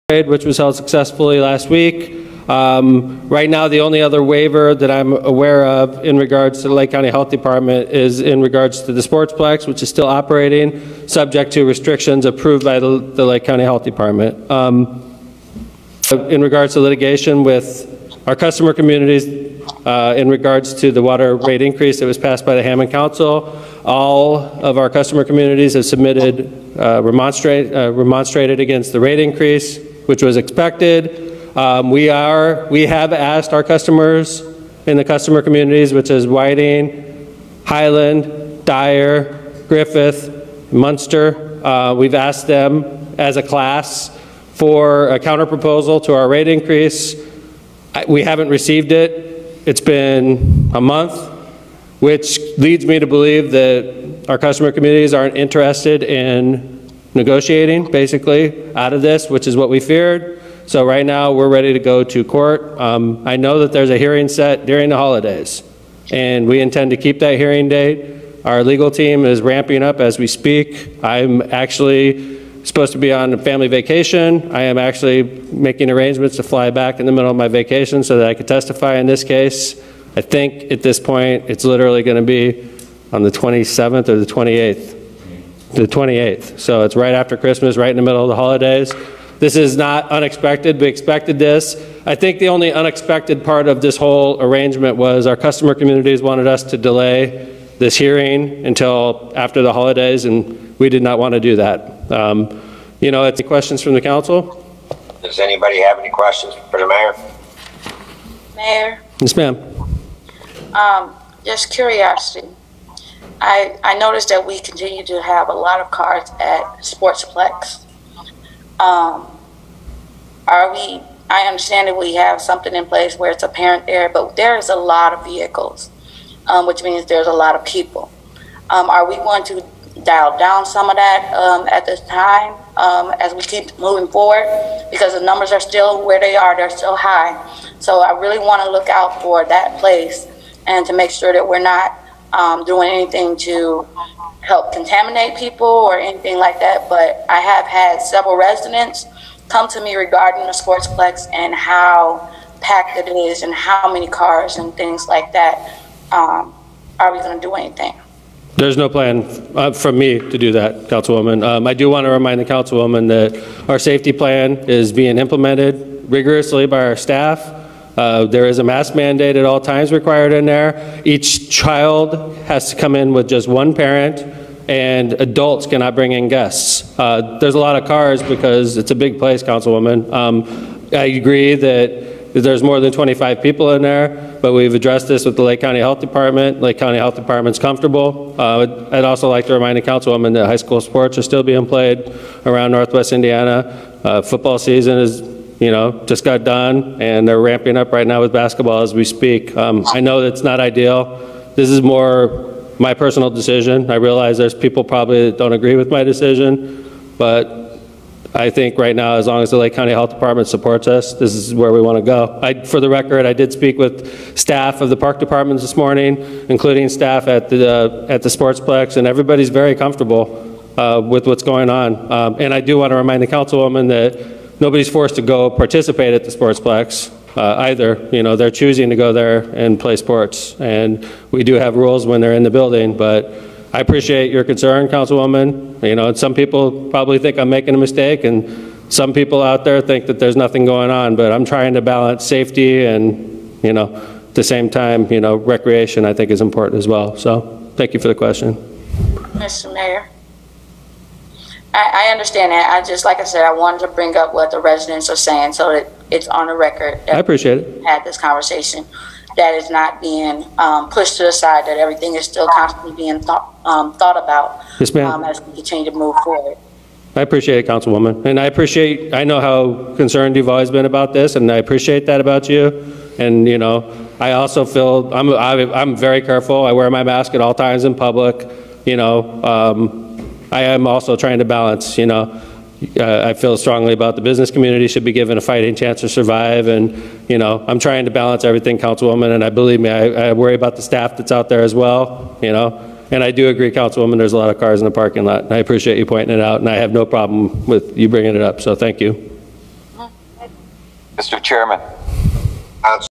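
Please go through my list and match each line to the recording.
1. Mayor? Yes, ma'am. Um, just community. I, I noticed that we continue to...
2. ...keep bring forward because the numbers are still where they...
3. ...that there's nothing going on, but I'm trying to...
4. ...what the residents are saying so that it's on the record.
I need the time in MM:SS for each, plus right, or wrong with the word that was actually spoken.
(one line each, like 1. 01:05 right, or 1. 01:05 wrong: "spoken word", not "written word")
1. 01:48 wrong: "curiosity", not "community"
2. 02:13 wrong: "moving", not "bring"
3. 04:00 right
4. 04:14 right.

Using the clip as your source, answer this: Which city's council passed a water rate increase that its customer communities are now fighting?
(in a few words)
Hammond.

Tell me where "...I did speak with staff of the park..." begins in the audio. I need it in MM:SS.
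03:33.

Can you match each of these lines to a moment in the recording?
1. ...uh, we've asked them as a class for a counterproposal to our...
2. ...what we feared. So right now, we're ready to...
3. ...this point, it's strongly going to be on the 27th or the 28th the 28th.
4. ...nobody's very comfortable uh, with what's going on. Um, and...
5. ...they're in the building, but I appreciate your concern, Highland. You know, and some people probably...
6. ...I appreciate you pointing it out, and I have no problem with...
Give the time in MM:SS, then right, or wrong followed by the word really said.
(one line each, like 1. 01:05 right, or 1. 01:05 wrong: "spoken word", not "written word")
1. 00:41 right
2. 00:59 right
3. 01:20 wrong: "literally", not "strongly"
4. 03:39 wrong: "everybody", not "nobody"
5. 03:52 wrong: "Councilwoman", not "Highland"
6. 04:55 right.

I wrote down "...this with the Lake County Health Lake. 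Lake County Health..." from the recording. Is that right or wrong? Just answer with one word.
wrong.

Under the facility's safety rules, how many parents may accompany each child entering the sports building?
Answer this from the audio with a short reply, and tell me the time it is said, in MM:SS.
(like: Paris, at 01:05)
1, at 02:53.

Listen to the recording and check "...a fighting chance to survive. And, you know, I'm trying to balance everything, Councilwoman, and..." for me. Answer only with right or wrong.
right.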